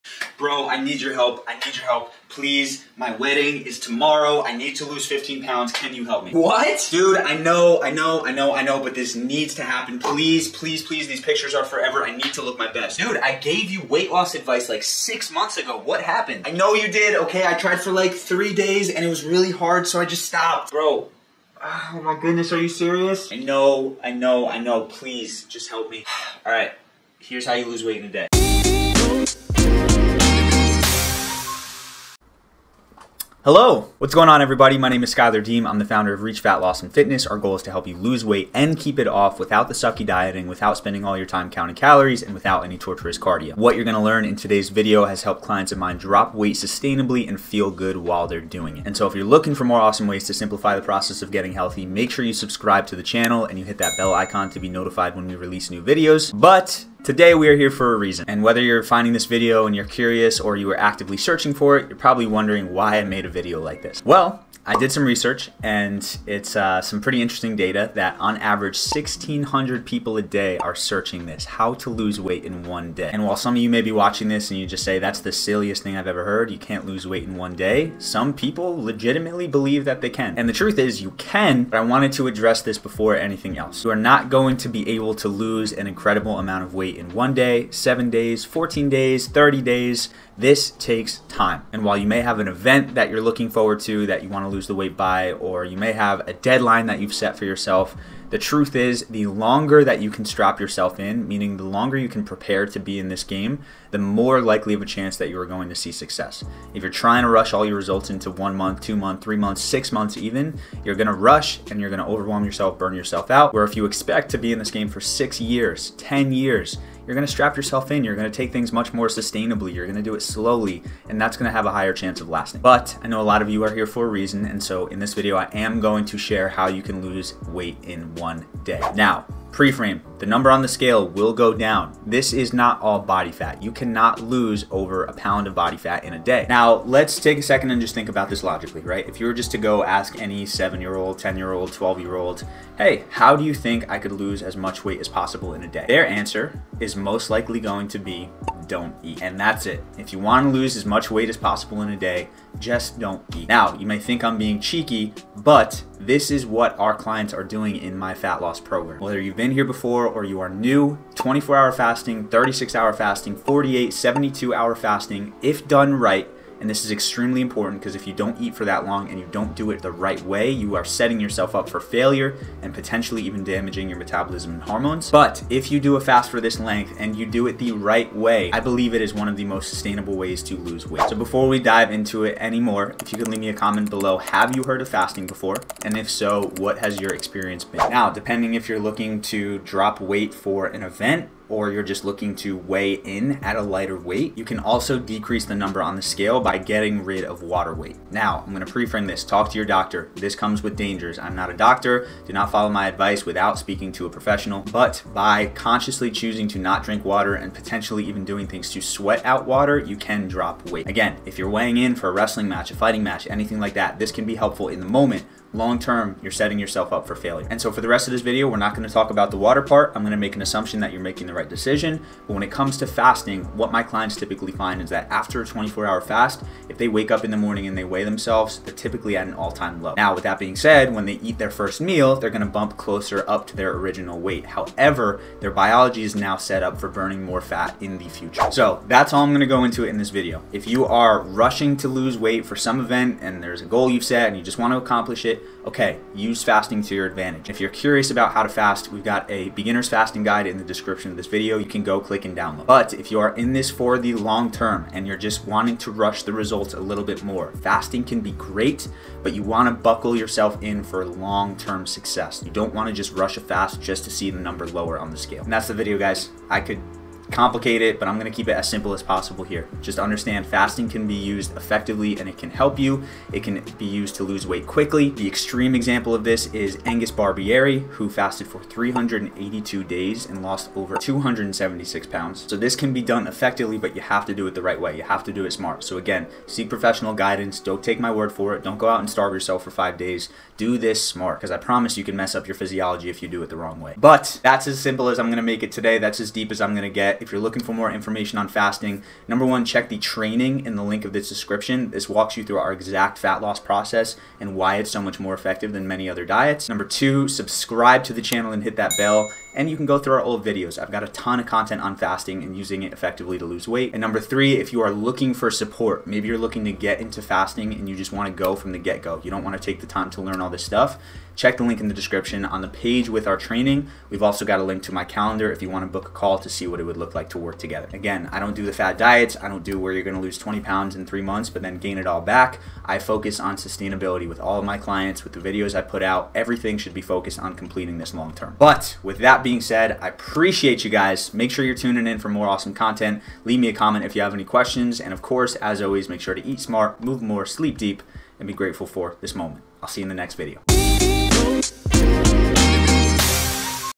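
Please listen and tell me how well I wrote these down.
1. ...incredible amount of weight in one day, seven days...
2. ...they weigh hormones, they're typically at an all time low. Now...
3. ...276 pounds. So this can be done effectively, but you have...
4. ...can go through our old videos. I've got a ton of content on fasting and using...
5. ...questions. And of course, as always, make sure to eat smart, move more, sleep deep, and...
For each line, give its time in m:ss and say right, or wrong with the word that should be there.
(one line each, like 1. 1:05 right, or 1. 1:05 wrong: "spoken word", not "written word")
1. 1:25 right
2. 3:47 wrong: "themselves", not "hormones"
3. 4:40 right
4. 5:09 right
5. 5:44 right.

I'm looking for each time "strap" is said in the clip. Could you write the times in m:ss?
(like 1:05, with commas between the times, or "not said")
1:40, 1:57.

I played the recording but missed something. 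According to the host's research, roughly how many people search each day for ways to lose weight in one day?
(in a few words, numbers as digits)
1,600.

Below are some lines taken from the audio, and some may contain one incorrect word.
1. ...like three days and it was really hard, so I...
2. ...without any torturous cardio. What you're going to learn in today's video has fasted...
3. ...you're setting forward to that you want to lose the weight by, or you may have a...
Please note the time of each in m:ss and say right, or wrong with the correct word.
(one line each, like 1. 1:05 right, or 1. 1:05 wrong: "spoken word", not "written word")
1. 0:17 right
2. 0:42 wrong: "helped", not "fasted"
3. 1:33 wrong: "looking", not "setting".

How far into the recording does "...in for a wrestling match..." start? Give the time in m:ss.
3:31.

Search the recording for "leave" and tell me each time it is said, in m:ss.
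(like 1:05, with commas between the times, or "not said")
3:03, 5:43.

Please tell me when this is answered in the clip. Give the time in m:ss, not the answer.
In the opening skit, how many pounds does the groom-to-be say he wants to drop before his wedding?
0:05.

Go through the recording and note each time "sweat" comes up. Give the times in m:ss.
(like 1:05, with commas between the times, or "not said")
3:28.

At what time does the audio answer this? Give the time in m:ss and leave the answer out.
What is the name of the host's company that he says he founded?
0:36.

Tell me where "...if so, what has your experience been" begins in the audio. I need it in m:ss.
3:05.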